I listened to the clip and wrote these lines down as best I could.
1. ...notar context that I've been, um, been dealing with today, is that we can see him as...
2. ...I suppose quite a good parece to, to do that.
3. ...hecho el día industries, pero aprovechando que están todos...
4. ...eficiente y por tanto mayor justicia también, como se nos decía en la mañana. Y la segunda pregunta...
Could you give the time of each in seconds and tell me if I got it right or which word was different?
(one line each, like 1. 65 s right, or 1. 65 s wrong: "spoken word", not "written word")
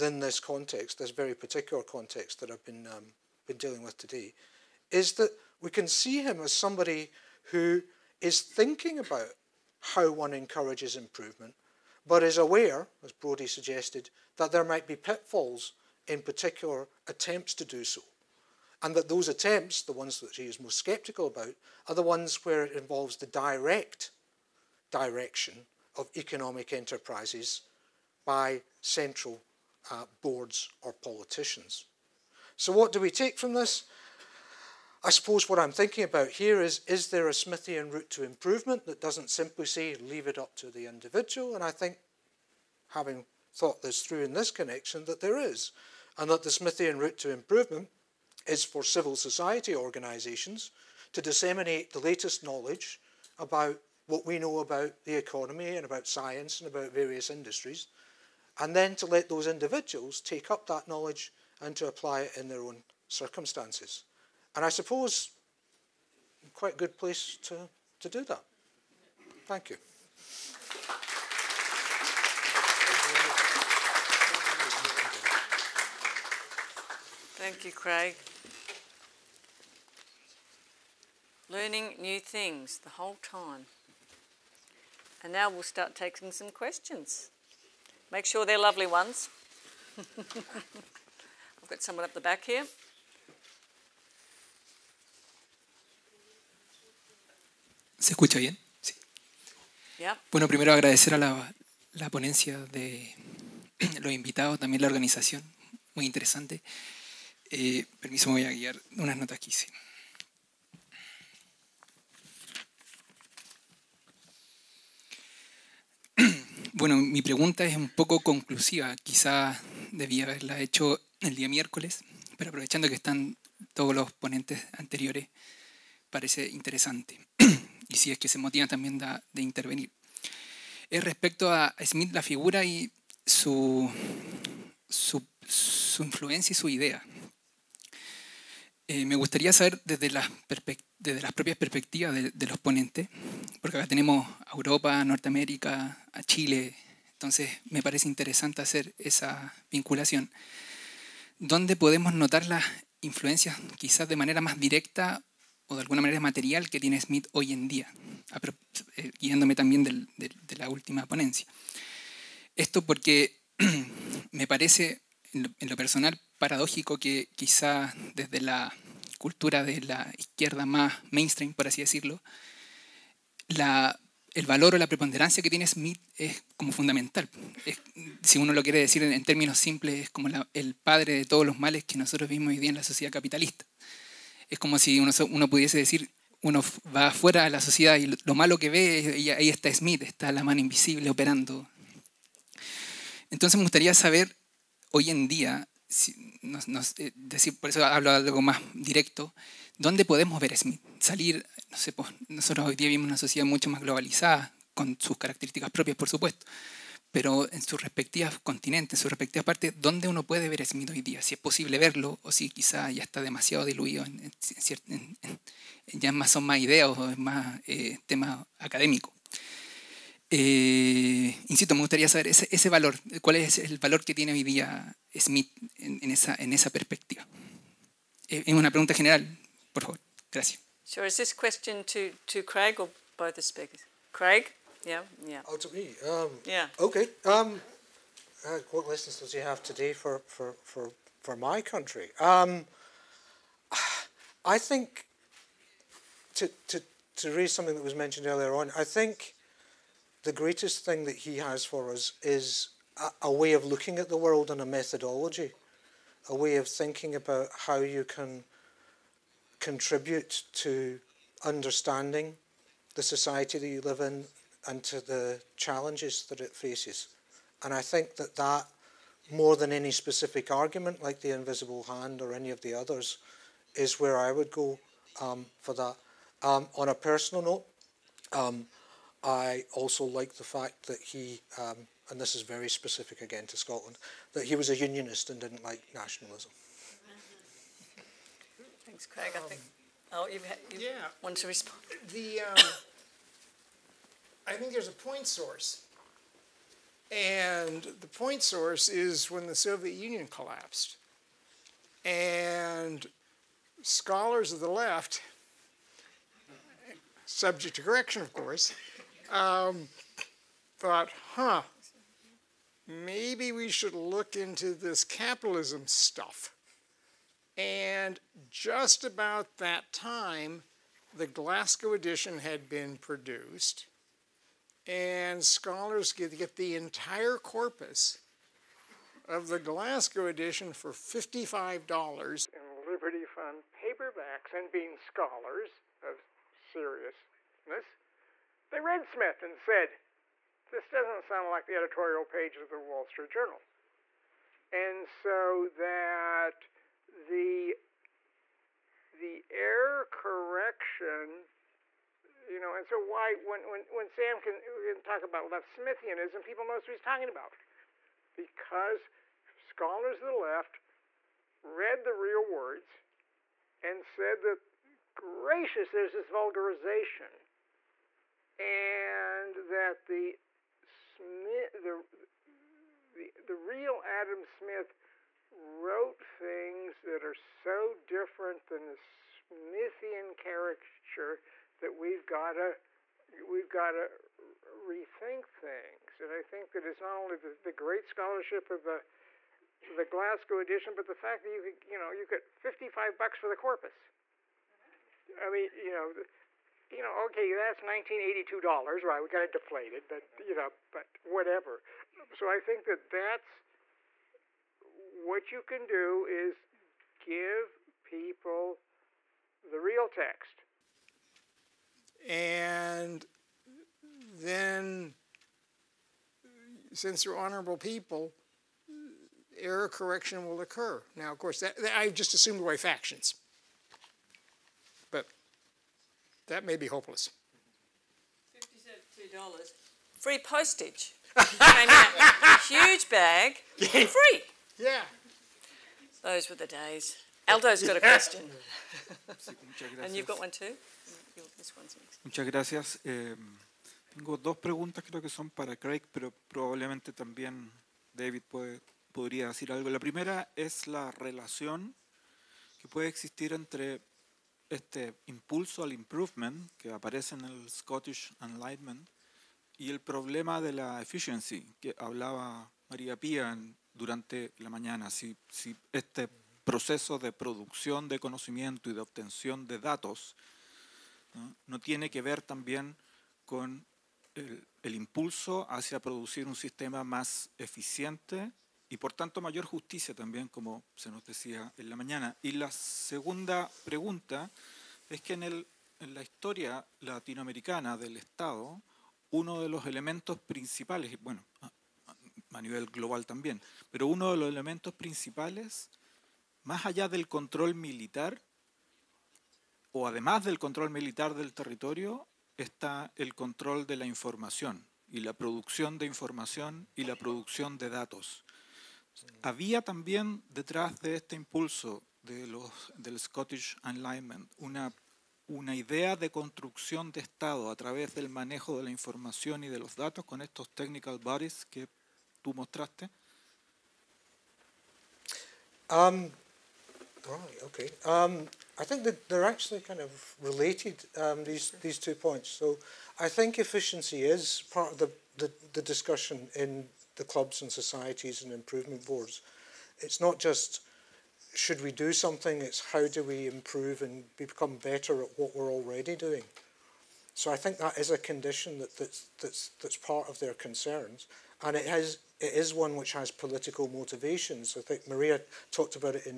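1. 1 s wrong: "particular", not "notar"
2. 64 s wrong: "place", not "parece"
3. 120 s wrong: "miércoles", not "industries"
4. 477 s right.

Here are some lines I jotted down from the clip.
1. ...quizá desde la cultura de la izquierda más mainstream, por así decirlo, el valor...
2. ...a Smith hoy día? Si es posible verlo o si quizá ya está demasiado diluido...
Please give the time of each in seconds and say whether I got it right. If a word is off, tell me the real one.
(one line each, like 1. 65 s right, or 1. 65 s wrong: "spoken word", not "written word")
1. 167 s right
2. 210 s right.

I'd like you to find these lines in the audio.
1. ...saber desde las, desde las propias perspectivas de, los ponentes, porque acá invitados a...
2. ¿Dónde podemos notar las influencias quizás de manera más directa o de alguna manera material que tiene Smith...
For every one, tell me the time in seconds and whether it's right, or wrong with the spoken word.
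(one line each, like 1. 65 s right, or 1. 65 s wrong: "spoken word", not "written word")
1. 139 s wrong: "tenemos", not "invitados"
2. 151 s right.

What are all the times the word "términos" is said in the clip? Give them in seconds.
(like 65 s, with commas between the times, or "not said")
179 s.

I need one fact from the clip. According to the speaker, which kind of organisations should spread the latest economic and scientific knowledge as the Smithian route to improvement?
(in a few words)
civil society organisations.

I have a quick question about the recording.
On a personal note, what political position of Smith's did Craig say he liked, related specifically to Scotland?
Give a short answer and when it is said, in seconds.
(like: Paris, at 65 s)
unionist, at 284 s.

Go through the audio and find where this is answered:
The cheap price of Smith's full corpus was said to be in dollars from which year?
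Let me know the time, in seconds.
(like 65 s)
397 s.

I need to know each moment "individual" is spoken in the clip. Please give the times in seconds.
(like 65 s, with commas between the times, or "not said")
40 s, 59 s.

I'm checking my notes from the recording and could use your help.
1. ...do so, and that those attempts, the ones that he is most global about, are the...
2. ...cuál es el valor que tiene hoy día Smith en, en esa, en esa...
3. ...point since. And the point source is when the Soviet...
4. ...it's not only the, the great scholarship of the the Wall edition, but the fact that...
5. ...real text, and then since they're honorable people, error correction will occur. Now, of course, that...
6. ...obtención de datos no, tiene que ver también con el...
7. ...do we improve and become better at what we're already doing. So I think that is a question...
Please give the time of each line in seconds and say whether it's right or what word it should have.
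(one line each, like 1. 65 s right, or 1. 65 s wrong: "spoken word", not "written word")
1. 17 s wrong: "sceptical", not "global"
2. 223 s right
3. 294 s wrong: "source", not "since"
4. 386 s wrong: "Glasgow", not "Wall"
5. 409 s right
6. 468 s right
7. 543 s wrong: "condition", not "question".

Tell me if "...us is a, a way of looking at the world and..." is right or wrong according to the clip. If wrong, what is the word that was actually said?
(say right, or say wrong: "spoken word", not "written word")
right.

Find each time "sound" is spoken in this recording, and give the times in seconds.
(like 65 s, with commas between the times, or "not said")
341 s.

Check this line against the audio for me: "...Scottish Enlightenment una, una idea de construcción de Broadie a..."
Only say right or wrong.
wrong.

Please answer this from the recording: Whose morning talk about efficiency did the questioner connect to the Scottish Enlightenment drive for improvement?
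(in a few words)
María Pía.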